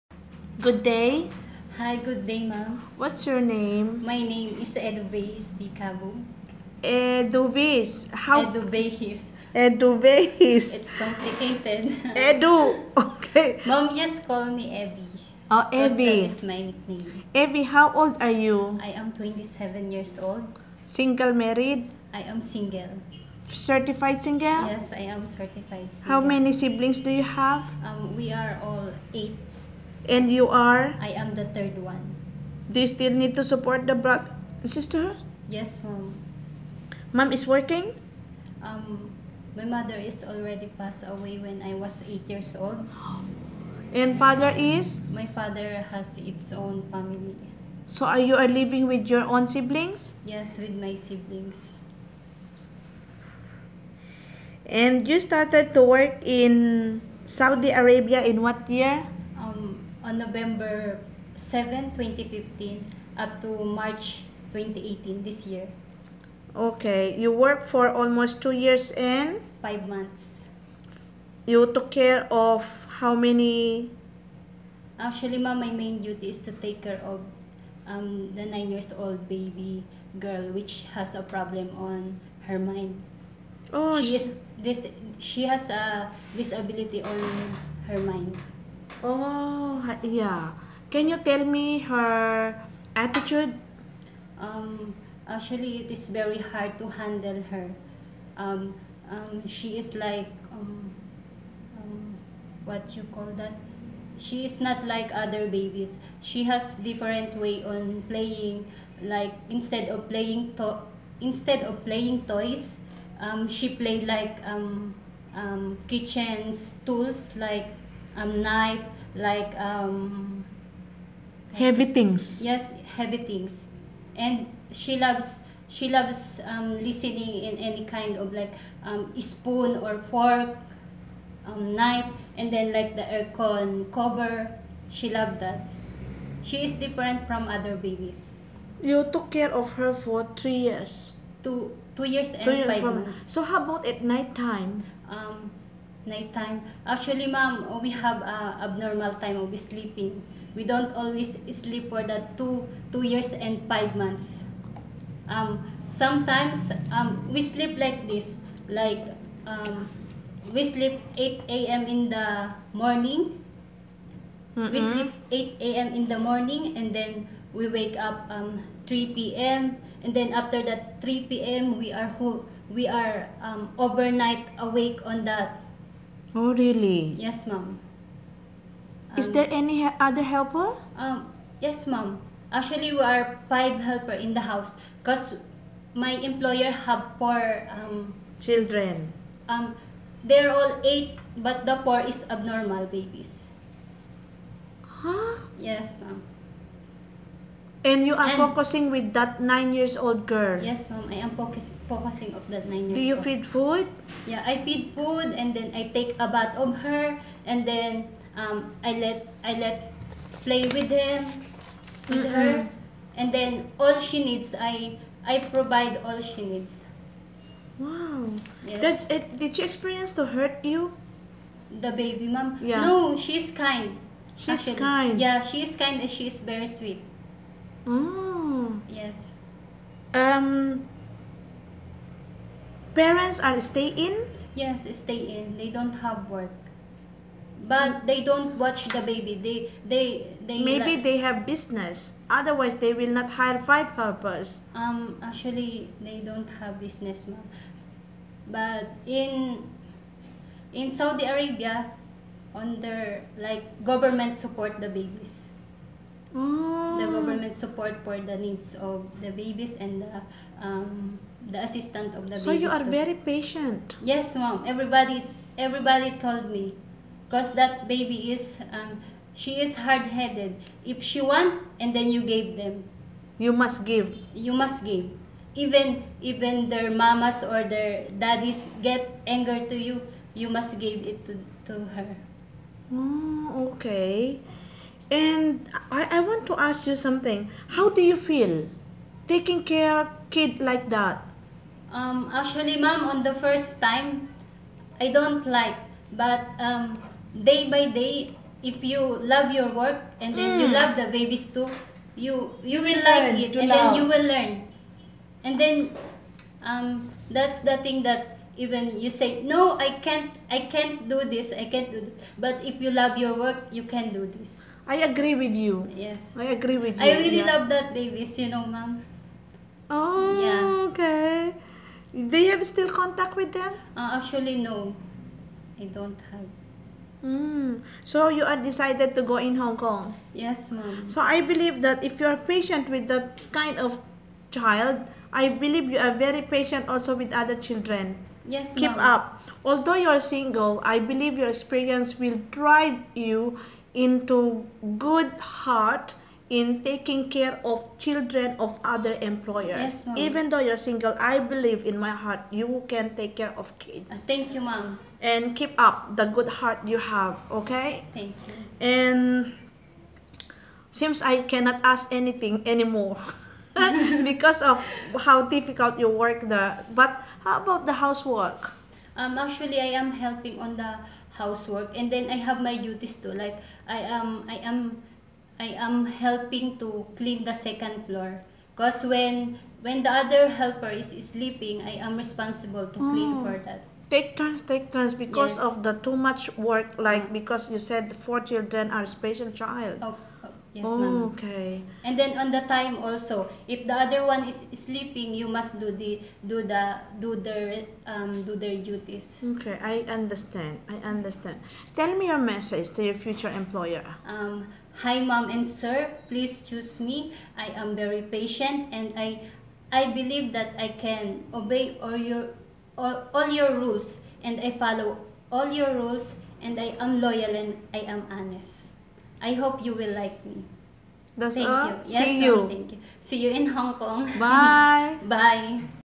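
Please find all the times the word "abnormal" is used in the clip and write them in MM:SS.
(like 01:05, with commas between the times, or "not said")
02:28, 03:12.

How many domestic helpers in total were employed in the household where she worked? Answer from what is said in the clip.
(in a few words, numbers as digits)
5.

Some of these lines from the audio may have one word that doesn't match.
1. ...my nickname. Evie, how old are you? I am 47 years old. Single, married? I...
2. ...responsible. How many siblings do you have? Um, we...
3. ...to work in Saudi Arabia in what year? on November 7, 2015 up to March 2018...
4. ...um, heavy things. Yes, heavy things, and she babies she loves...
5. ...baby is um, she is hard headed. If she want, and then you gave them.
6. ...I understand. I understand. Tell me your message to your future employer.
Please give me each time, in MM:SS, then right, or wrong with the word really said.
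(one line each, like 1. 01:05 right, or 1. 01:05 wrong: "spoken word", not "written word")
1. 00:16 wrong: "27", not "47"
2. 00:25 wrong: "single", not "responsible"
3. 00:55 right
4. 01:59 wrong: "loves", not "babies"
5. 04:27 right
6. 06:39 right.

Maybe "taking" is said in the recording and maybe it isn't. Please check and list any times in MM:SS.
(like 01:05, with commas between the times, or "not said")
04:49, 05:46.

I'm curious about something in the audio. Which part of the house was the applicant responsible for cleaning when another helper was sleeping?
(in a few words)
Second floor.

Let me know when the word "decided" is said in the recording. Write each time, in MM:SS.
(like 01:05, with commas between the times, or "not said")
05:28.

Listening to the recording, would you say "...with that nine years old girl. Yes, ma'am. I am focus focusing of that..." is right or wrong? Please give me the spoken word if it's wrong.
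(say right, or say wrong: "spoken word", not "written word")
right.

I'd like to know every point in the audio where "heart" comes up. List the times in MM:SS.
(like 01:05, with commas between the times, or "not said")
05:45, 05:52, 05:56.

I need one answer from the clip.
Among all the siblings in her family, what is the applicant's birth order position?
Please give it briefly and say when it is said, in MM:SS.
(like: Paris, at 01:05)
Third, at 00:31.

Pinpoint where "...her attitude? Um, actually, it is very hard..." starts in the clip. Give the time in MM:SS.
01:31.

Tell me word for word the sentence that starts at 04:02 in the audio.
Otherwise they will not hire five helpers.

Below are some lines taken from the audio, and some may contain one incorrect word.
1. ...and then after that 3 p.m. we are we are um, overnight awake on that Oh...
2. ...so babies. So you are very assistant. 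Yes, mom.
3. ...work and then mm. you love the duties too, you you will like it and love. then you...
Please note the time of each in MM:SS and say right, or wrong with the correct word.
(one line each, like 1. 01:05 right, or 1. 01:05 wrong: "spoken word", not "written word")
1. 02:50 right
2. 04:22 wrong: "patient", not "assistant"
3. 04:59 wrong: "babies", not "duties".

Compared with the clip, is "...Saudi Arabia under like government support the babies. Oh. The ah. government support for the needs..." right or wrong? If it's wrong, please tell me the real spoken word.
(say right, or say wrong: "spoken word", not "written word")
right.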